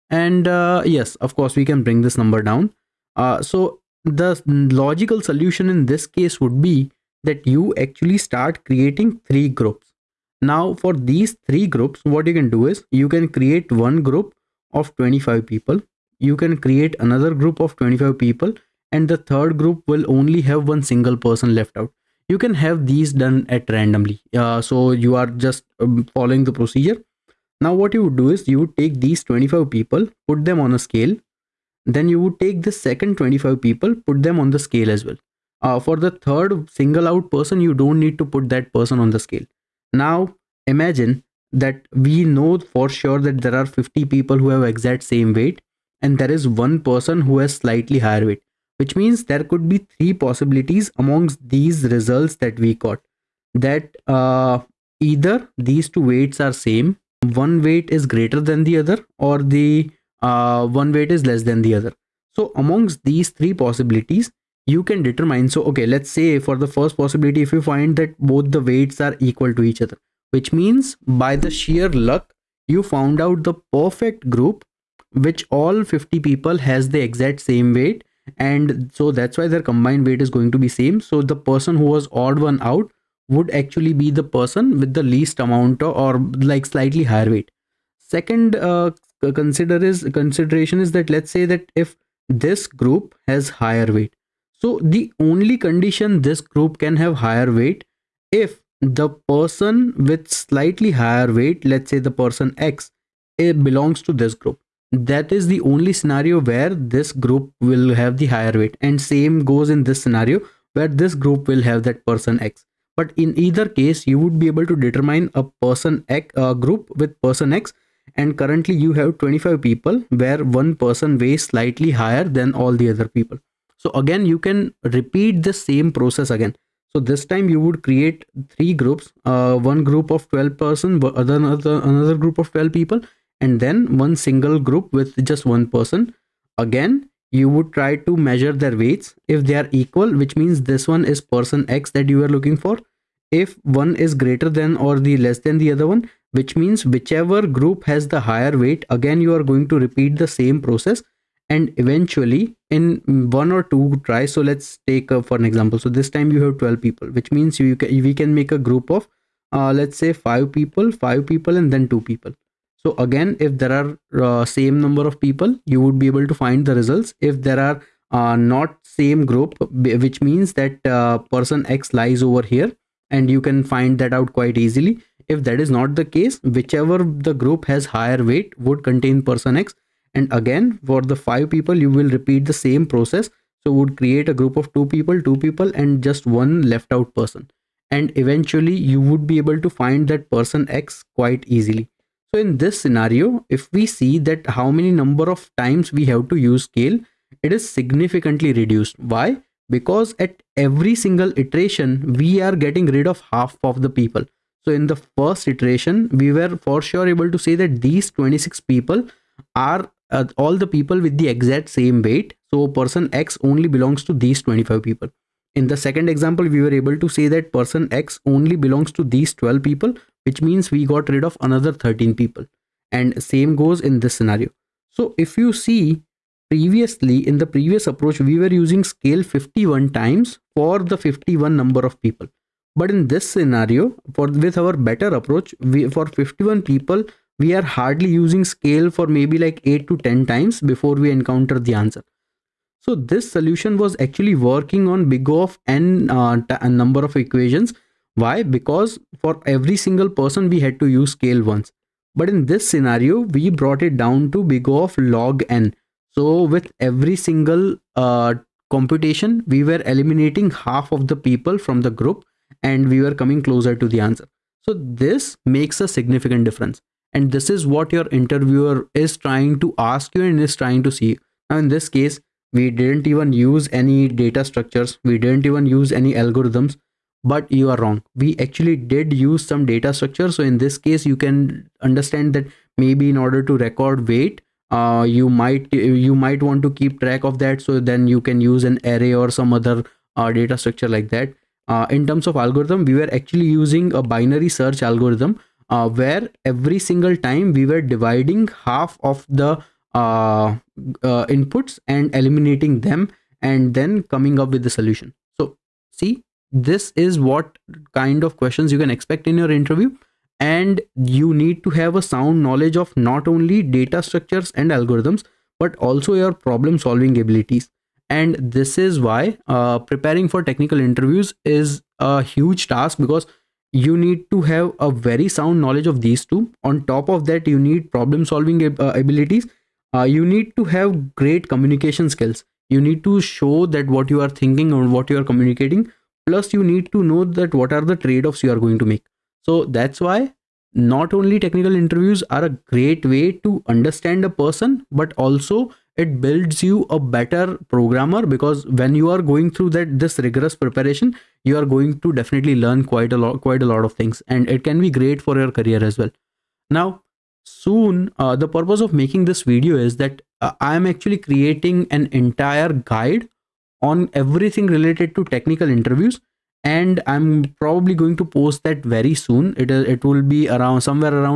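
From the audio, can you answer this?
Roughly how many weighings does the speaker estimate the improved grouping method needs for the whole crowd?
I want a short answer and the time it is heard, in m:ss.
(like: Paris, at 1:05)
8 to 10, at 3:59.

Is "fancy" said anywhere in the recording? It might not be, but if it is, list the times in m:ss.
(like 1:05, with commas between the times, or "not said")
not said.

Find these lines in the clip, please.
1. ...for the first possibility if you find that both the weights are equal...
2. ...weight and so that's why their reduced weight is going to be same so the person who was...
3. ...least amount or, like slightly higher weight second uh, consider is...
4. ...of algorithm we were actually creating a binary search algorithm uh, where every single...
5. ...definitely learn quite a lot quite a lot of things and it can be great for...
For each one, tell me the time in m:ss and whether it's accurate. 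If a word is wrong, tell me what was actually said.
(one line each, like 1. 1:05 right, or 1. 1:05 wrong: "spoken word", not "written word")
1. 1:06 right
2. 1:17 wrong: "combined", not "reduced"
3. 1:25 right
4. 4:52 wrong: "using", not "creating"
5. 5:52 right.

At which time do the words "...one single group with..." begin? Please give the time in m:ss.
2:13.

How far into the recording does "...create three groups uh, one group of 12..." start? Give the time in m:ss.
2:07.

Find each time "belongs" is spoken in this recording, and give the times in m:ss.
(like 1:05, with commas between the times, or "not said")
1:43, 3:33, 3:38.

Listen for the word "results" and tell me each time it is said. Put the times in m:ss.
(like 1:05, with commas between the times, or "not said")
0:51, 2:46.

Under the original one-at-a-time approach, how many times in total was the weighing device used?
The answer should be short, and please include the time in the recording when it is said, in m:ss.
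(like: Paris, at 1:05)
51, at 3:49.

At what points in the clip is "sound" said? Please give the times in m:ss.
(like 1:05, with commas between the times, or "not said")
5:12, 5:25.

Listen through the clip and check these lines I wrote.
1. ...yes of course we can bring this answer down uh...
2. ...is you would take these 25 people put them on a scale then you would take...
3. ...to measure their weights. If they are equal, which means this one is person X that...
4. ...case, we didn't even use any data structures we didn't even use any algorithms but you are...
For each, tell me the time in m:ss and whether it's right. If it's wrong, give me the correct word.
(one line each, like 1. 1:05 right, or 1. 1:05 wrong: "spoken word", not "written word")
1. 0:00 wrong: "number", not "answer"
2. 0:28 right
3. 2:18 right
4. 4:31 right.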